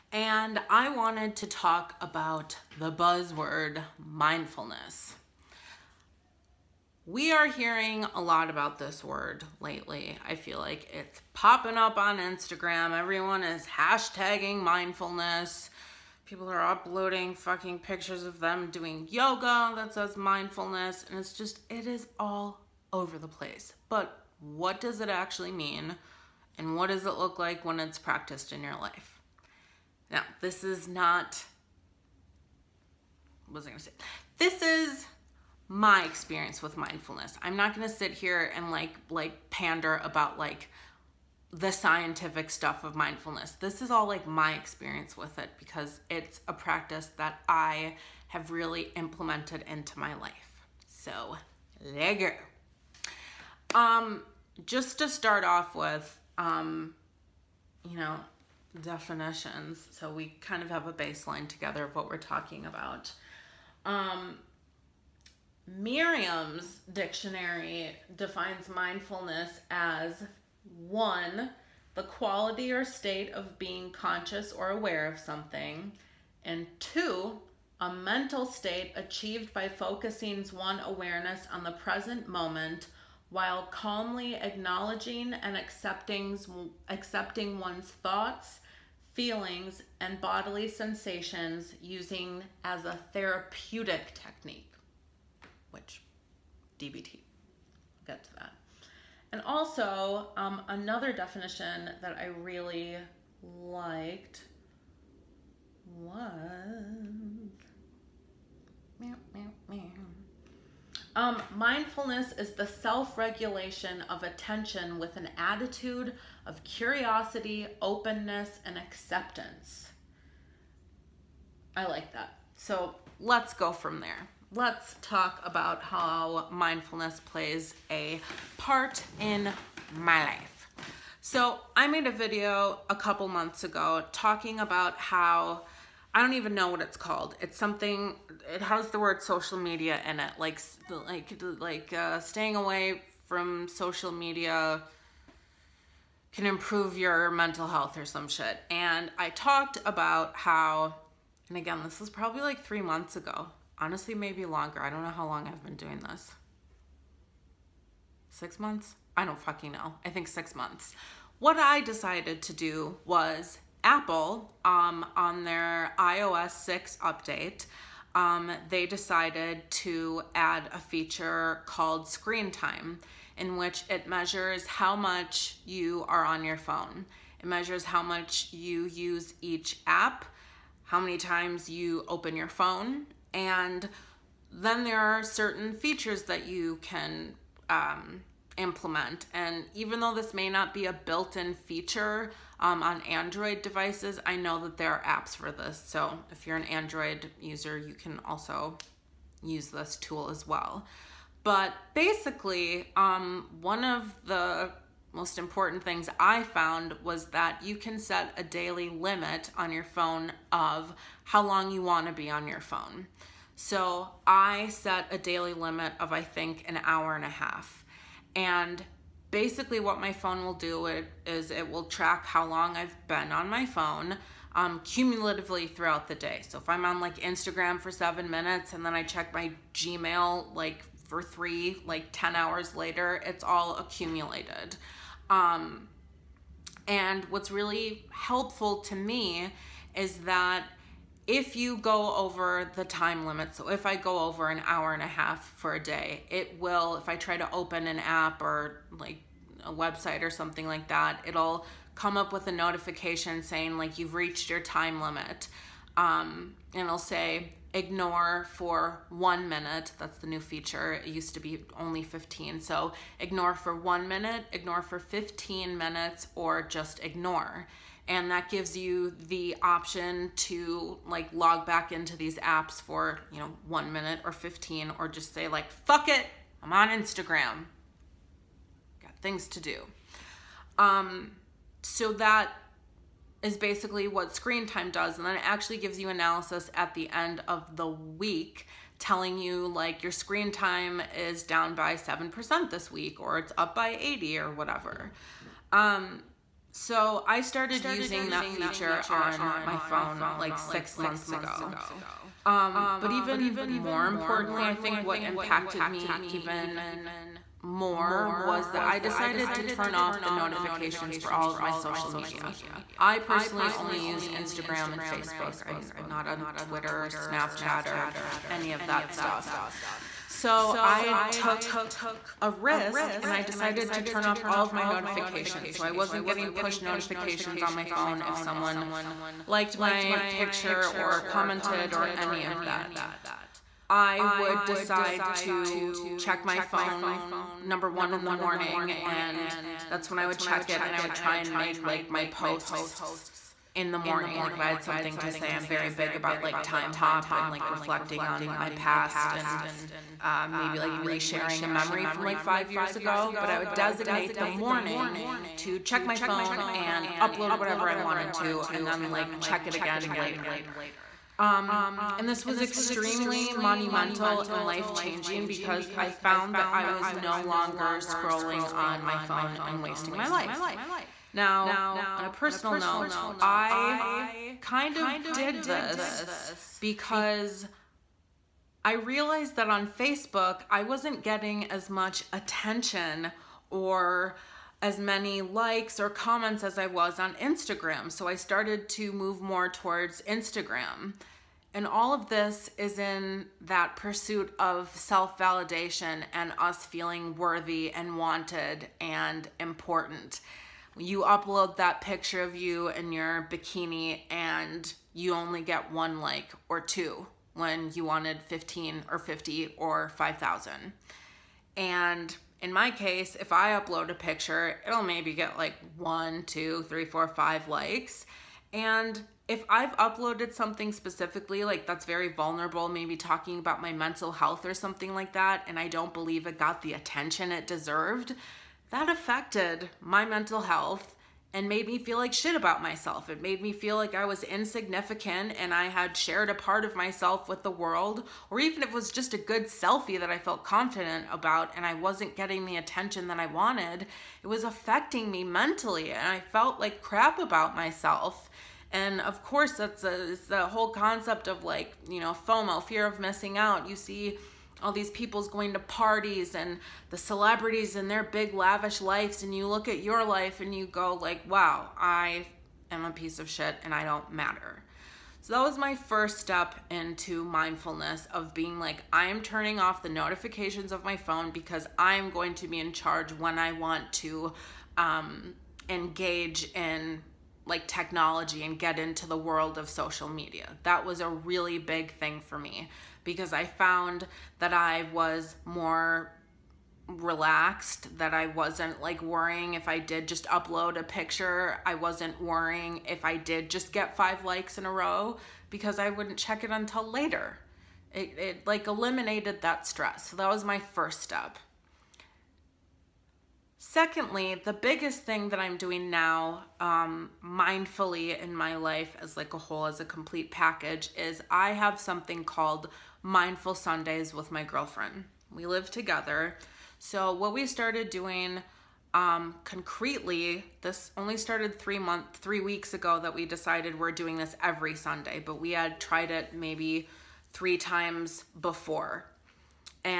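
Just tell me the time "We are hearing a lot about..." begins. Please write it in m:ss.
0:07.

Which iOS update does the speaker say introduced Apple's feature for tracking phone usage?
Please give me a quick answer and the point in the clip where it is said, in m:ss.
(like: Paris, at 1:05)
iOS 6, at 2:45.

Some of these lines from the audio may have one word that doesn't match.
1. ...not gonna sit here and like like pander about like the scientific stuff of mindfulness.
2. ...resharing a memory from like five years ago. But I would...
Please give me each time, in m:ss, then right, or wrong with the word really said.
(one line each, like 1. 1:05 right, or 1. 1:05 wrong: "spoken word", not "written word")
1. 0:37 right
2. 5:50 right.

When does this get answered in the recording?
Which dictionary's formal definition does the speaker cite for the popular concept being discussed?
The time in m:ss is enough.
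1:05.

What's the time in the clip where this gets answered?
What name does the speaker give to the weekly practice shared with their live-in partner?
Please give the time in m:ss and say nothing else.
8:33.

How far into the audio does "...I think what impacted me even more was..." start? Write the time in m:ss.
5:04.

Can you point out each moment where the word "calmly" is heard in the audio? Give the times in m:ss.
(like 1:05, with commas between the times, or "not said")
1:23.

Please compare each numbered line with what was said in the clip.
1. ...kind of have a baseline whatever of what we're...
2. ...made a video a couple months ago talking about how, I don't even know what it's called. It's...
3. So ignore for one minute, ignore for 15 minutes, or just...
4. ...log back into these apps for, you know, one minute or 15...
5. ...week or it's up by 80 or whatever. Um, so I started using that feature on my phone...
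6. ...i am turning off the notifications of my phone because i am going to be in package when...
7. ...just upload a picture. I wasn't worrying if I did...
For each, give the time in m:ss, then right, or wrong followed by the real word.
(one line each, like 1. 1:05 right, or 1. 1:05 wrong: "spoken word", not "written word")
1. 1:00 wrong: "together", not "whatever"
2. 2:11 right
3. 4:22 right
4. 4:31 right
5. 4:52 right
6. 7:49 wrong: "charge", not "package"
7. 8:10 right.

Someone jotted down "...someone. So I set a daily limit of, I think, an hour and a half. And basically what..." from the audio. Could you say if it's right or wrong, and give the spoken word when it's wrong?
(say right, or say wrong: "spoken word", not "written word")
wrong: "phone", not "someone".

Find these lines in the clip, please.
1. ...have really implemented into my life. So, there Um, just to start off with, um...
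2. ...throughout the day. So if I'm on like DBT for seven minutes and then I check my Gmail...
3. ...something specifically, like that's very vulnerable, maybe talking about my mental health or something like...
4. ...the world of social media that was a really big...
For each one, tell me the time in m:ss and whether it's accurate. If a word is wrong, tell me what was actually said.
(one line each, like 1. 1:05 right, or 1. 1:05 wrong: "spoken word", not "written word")
1. 0:48 right
2. 3:45 wrong: "Instagram", not "DBT"
3. 7:00 right
4. 7:59 right.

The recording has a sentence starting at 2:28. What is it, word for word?
And I talked about how, and again, this was probably like three months ago, honestly maybe longer.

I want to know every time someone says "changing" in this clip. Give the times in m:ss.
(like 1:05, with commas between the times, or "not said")
6:04.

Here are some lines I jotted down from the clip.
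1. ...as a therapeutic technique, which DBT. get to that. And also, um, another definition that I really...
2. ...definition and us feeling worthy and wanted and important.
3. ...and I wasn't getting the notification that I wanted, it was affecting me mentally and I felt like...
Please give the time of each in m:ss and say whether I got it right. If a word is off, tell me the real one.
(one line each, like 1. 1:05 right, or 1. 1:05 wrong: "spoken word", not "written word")
1. 1:32 right
2. 6:35 wrong: "validation", not "definition"
3. 7:21 wrong: "attention", not "notification".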